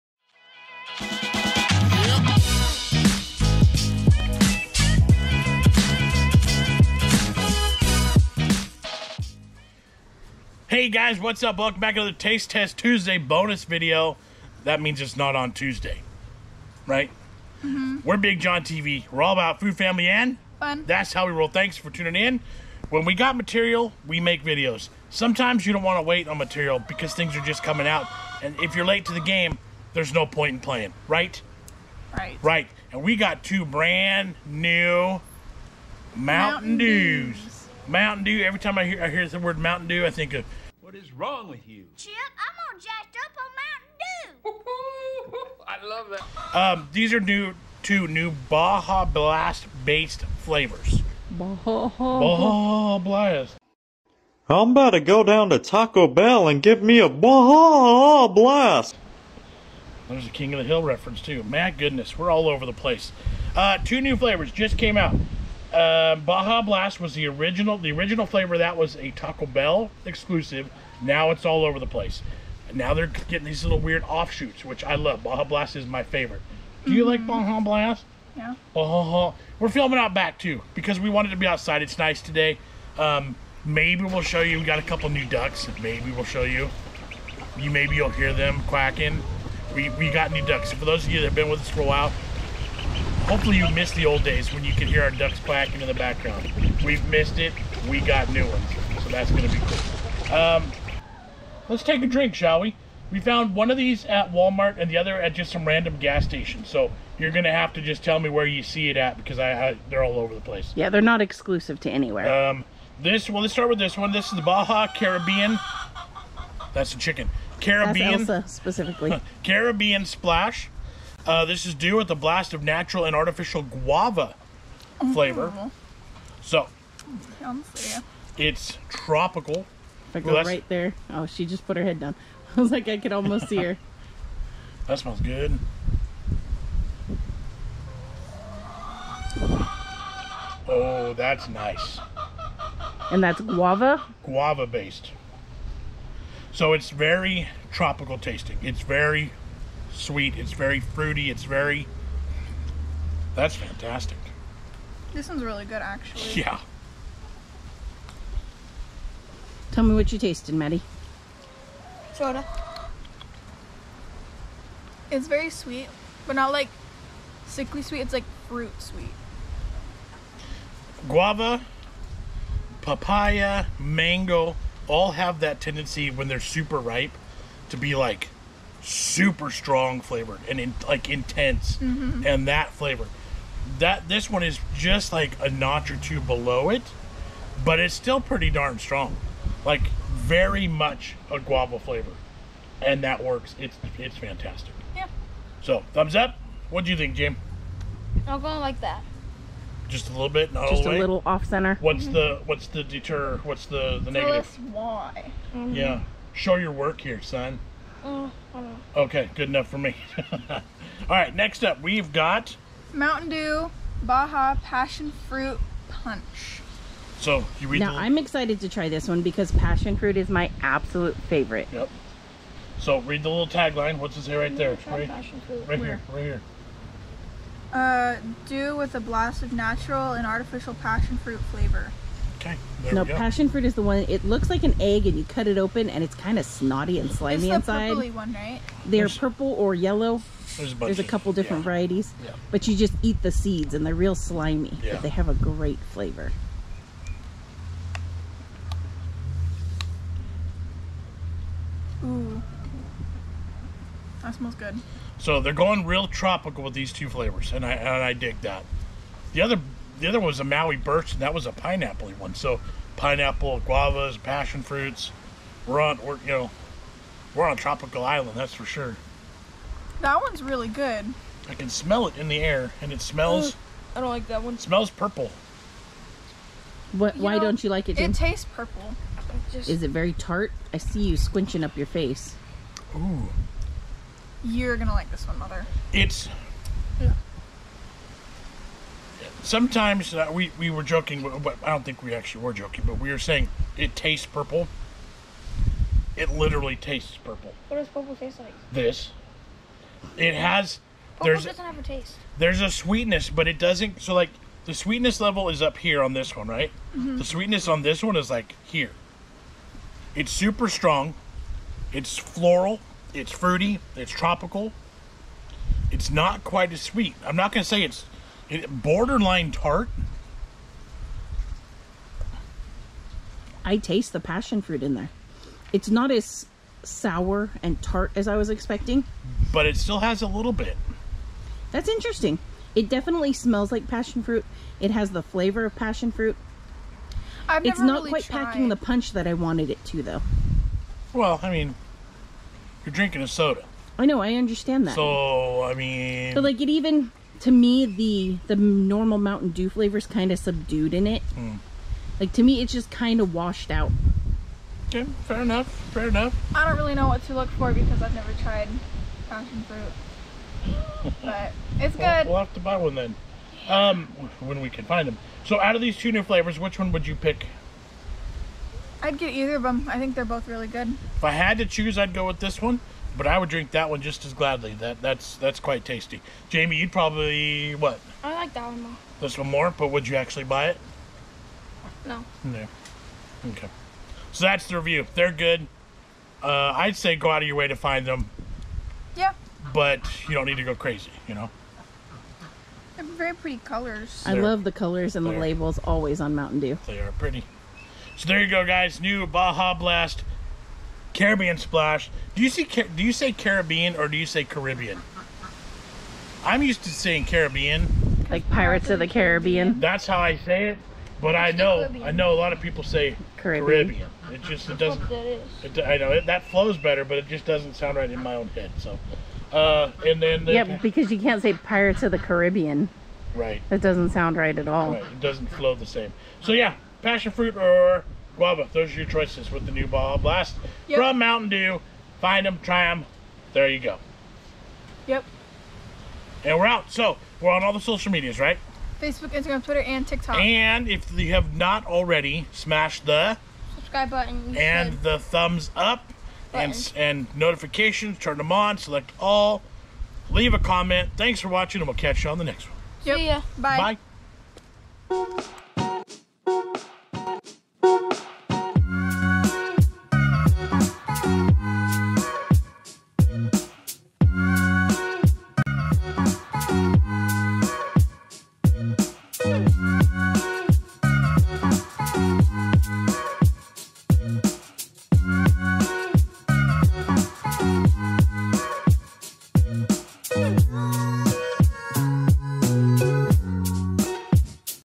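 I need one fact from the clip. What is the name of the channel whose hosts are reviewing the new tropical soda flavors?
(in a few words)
BigJon TV.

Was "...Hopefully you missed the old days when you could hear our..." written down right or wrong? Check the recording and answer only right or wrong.
right.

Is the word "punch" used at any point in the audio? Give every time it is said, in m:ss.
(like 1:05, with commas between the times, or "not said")
3:35, 5:38.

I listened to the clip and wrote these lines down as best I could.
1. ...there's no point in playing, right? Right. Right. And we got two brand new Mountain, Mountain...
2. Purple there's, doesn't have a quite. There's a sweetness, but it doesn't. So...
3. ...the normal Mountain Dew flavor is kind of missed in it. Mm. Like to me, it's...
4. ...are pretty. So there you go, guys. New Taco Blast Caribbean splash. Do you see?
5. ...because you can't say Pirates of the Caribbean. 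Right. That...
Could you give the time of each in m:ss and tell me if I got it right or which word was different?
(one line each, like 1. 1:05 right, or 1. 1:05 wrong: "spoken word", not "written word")
1. 0:29 right
2. 5:01 wrong: "taste", not "quite"
3. 5:48 wrong: "subdued", not "missed"
4. 6:36 wrong: "Baja", not "Taco"
5. 7:00 right.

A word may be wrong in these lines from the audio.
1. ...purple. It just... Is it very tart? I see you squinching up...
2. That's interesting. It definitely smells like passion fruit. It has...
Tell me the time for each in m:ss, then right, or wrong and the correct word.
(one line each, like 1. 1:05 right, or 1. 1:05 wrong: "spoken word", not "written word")
1. 4:38 right
2. 5:31 right.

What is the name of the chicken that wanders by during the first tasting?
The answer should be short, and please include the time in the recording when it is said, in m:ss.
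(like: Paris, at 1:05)
Elsa, at 1:58.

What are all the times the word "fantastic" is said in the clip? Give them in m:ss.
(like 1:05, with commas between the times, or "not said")
2:33, 3:14.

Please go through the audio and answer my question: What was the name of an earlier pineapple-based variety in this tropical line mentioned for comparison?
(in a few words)
Maui Birch.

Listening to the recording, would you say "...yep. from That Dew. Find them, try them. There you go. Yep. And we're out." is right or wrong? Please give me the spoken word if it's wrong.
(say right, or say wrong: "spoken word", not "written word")
wrong: "Mountain", not "That".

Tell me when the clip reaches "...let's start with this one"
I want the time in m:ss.
1:53.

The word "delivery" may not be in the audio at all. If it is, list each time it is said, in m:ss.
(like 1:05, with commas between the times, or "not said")
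not said.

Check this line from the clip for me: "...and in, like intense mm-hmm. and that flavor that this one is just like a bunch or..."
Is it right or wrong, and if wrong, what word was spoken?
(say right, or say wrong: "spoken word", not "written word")
wrong: "notch", not "bunch".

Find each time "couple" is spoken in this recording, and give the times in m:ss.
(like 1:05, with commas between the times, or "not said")
1:24, 4:01.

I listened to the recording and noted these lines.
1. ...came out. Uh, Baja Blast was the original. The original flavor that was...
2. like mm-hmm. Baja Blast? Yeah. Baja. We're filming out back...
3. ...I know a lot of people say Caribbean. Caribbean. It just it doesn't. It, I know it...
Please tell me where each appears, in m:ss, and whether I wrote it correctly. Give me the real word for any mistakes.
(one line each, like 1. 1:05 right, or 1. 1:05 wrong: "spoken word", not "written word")
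1. 1:04 right
2. 1:17 right
3. 6:52 right.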